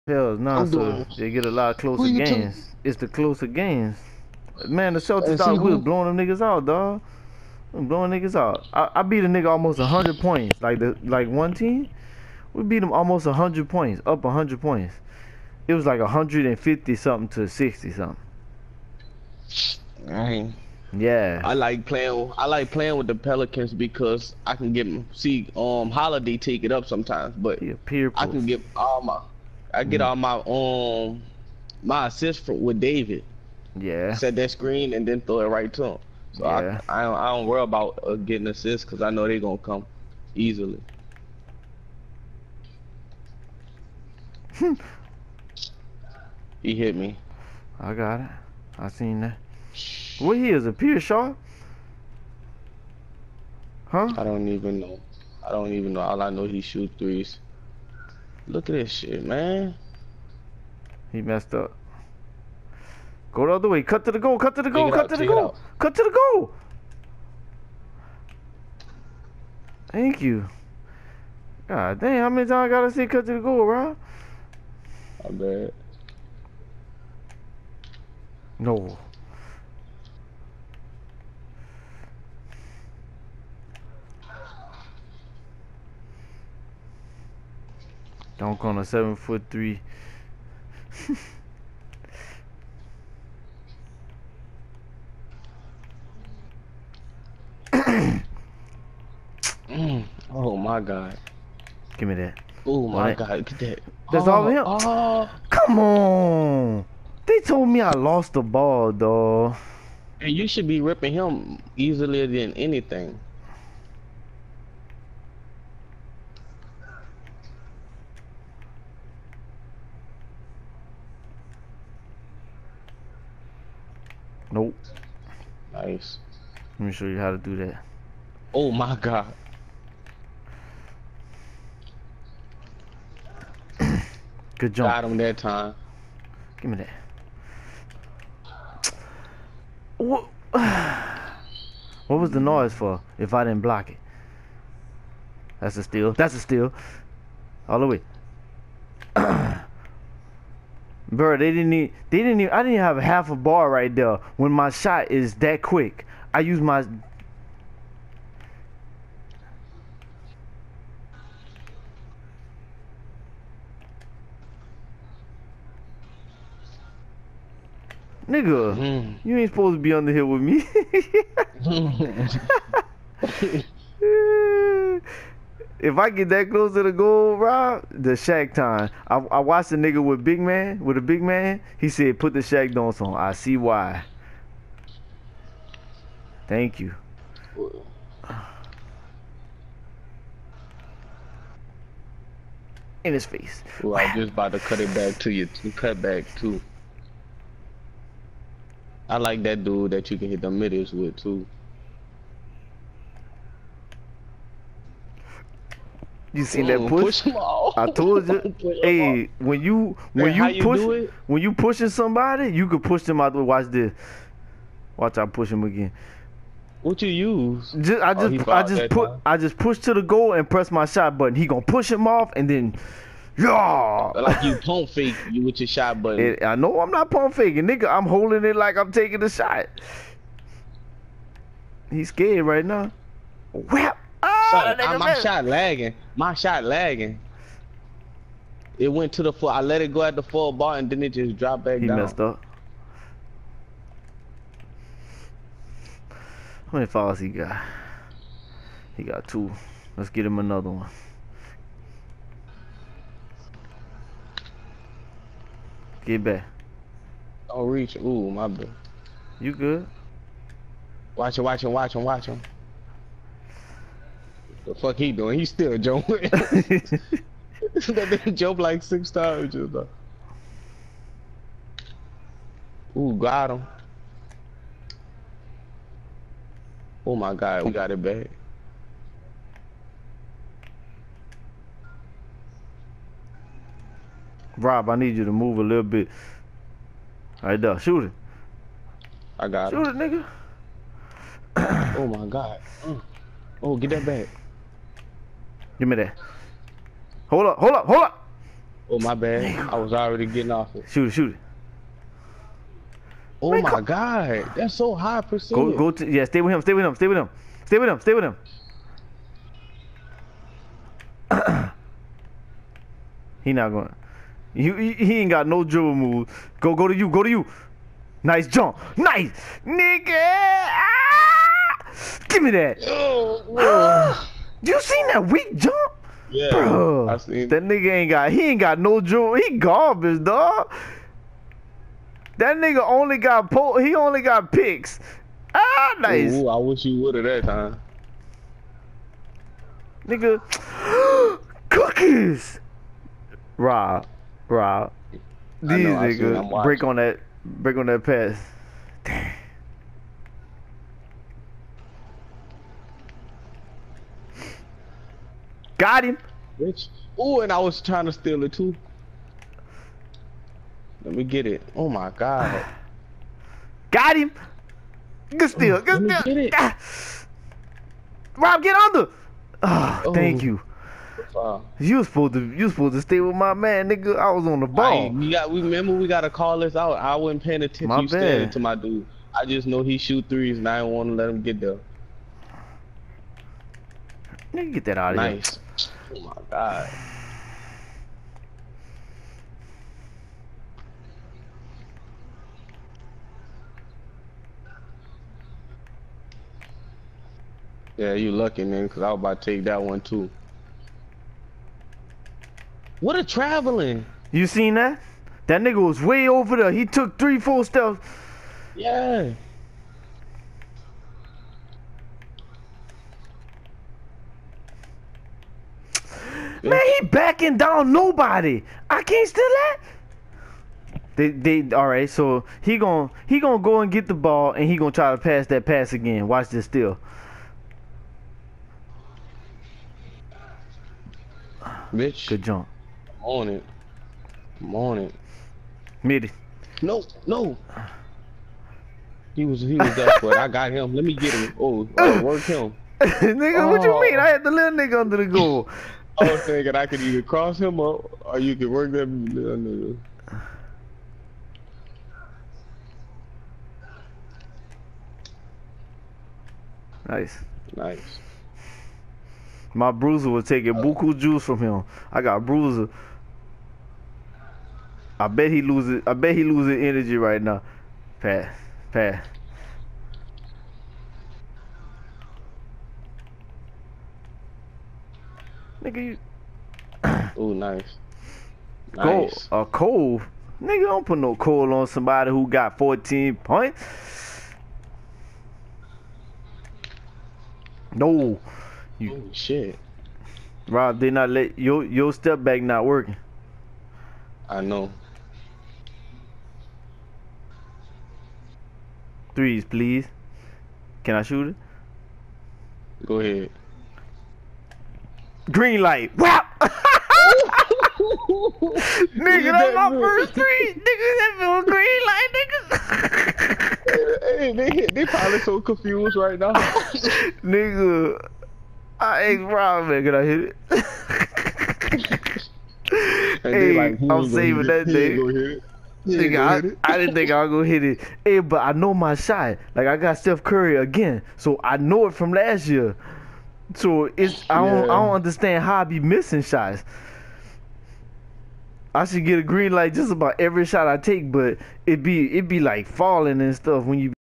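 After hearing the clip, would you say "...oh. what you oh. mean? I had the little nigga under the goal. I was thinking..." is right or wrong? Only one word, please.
right.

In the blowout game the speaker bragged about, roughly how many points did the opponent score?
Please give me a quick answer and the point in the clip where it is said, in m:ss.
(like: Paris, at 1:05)
60-something, at 0:17.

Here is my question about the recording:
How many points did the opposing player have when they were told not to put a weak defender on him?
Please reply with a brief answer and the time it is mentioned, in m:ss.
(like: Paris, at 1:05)
14, at 8:02.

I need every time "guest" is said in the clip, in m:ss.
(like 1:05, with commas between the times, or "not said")
not said.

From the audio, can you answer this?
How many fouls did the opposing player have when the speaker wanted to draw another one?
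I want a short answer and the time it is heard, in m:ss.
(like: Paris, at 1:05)
2, at 4:09.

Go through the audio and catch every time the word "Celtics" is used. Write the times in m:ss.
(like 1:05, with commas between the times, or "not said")
0:04.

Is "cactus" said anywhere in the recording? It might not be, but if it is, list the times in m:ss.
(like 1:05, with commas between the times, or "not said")
not said.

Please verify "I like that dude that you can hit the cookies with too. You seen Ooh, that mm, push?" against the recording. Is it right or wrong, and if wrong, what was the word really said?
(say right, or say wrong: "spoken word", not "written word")
wrong: "middles", not "cookies".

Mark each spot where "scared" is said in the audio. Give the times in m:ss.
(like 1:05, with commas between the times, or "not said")
3:52.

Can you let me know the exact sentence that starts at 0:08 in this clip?
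I, I beat a nigga almost hundred points.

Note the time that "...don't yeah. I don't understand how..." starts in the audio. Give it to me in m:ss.
8:54.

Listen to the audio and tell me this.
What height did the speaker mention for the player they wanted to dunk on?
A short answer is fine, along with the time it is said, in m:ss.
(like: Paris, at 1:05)
7 foot 3, at 1:28.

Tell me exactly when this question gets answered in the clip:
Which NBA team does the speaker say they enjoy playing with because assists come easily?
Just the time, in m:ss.
0:23.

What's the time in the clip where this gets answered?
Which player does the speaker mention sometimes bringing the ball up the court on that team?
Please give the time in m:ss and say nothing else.
0:25.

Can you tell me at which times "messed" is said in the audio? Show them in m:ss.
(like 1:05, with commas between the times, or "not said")
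1:01, 4:02.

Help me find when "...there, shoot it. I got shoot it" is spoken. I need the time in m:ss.
4:47.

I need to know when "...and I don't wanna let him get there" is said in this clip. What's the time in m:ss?
6:20.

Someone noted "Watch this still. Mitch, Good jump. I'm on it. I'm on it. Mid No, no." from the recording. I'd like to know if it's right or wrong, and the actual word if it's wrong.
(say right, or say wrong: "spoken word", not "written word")
right.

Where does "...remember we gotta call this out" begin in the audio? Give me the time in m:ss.
6:15.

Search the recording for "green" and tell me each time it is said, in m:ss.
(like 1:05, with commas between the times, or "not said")
8:25, 8:31, 8:59.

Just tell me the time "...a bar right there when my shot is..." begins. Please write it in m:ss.
2:33.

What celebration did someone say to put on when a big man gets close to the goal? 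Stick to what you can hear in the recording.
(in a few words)
The Shaq dance.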